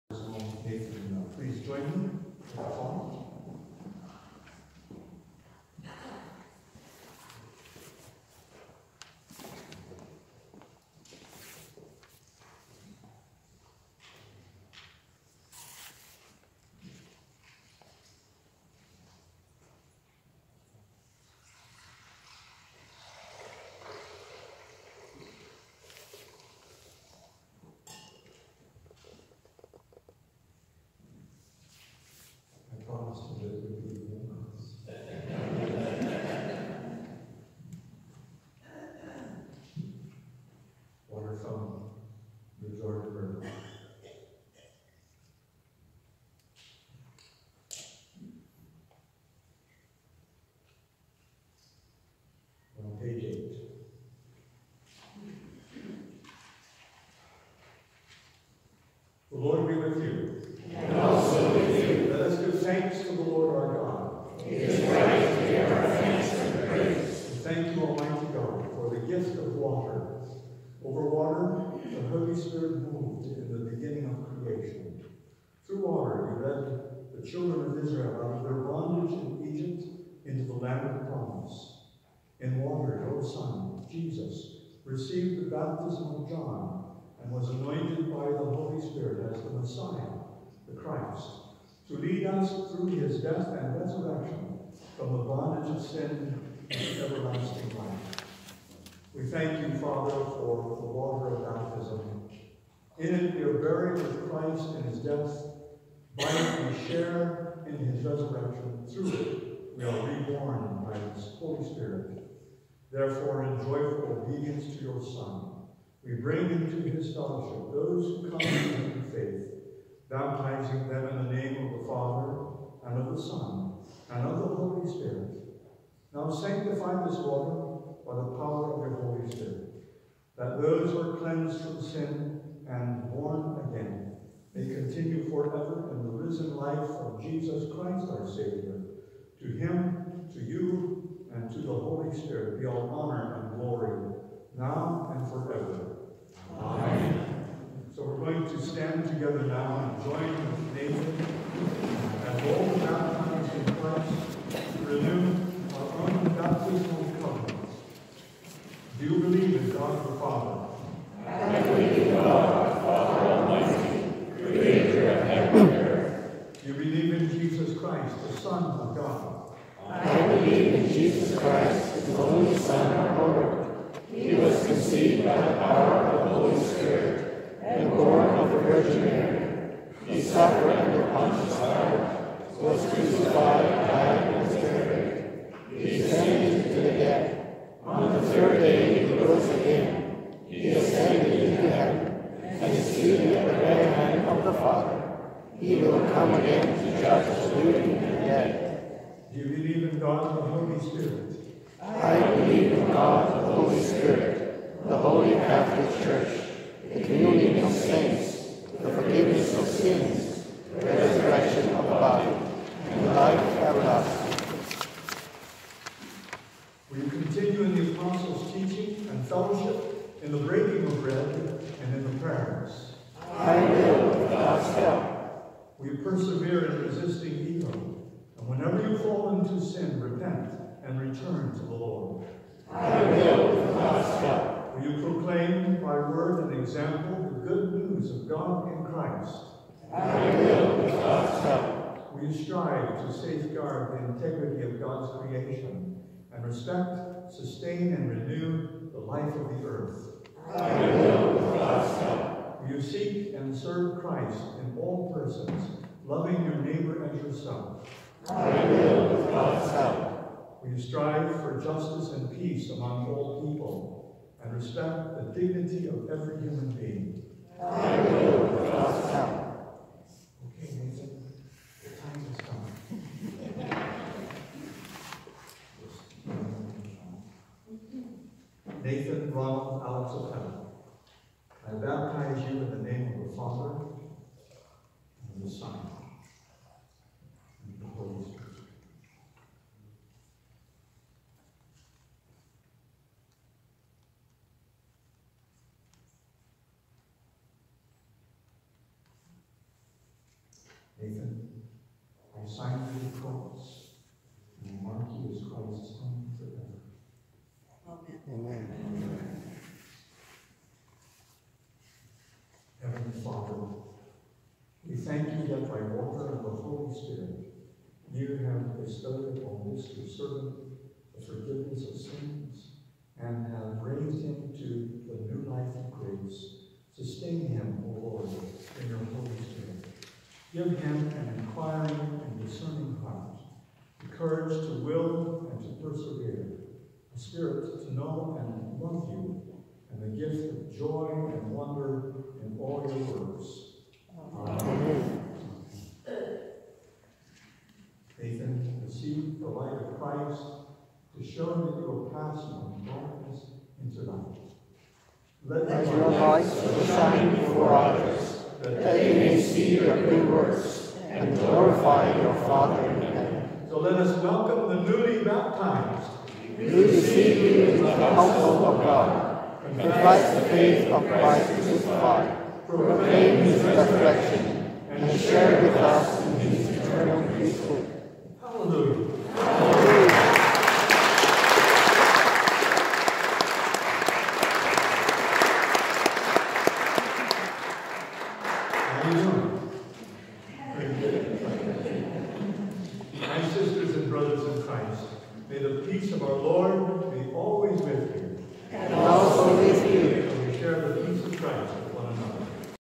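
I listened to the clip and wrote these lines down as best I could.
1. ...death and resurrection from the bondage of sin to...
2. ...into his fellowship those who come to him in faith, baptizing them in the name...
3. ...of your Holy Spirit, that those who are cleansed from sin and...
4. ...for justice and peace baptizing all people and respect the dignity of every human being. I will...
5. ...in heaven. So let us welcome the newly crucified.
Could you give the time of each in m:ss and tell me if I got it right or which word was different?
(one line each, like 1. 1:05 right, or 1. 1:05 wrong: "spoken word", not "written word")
1. 1:33 right
2. 1:56 right
3. 2:08 right
4. 4:21 wrong: "among", not "baptizing"
5. 6:02 wrong: "baptized", not "crucified".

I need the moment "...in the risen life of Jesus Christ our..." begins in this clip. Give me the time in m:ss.
2:15.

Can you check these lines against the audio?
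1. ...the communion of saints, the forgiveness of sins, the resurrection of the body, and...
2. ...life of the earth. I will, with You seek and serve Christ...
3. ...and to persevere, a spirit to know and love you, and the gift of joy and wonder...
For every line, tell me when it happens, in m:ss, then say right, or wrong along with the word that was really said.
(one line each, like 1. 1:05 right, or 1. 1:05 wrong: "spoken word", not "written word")
1. 3:26 right
2. 4:08 right
3. 5:35 right.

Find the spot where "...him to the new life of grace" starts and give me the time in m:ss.
5:24.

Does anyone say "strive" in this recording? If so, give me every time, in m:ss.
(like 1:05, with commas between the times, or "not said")
4:02, 4:20.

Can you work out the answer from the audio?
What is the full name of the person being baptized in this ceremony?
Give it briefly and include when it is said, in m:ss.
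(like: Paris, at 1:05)
Nathan Ronald Alex Apel, at 4:38.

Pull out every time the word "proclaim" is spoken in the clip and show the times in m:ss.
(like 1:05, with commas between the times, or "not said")
3:55, 6:12.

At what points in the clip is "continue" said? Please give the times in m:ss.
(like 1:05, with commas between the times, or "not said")
2:14, 3:37.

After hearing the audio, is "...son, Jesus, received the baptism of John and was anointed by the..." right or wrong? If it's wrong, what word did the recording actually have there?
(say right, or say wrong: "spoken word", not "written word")
right.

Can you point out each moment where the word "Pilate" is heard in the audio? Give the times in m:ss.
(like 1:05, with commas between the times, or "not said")
3:01.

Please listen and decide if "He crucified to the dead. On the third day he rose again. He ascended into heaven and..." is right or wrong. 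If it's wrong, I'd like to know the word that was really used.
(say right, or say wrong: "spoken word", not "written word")
wrong: "descended", not "crucified".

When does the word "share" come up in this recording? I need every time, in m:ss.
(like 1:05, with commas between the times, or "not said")
1:46, 6:15, 6:40.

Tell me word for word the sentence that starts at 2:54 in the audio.
He was conceived by the power of the Holy Spirit and born of the Virgin Mary.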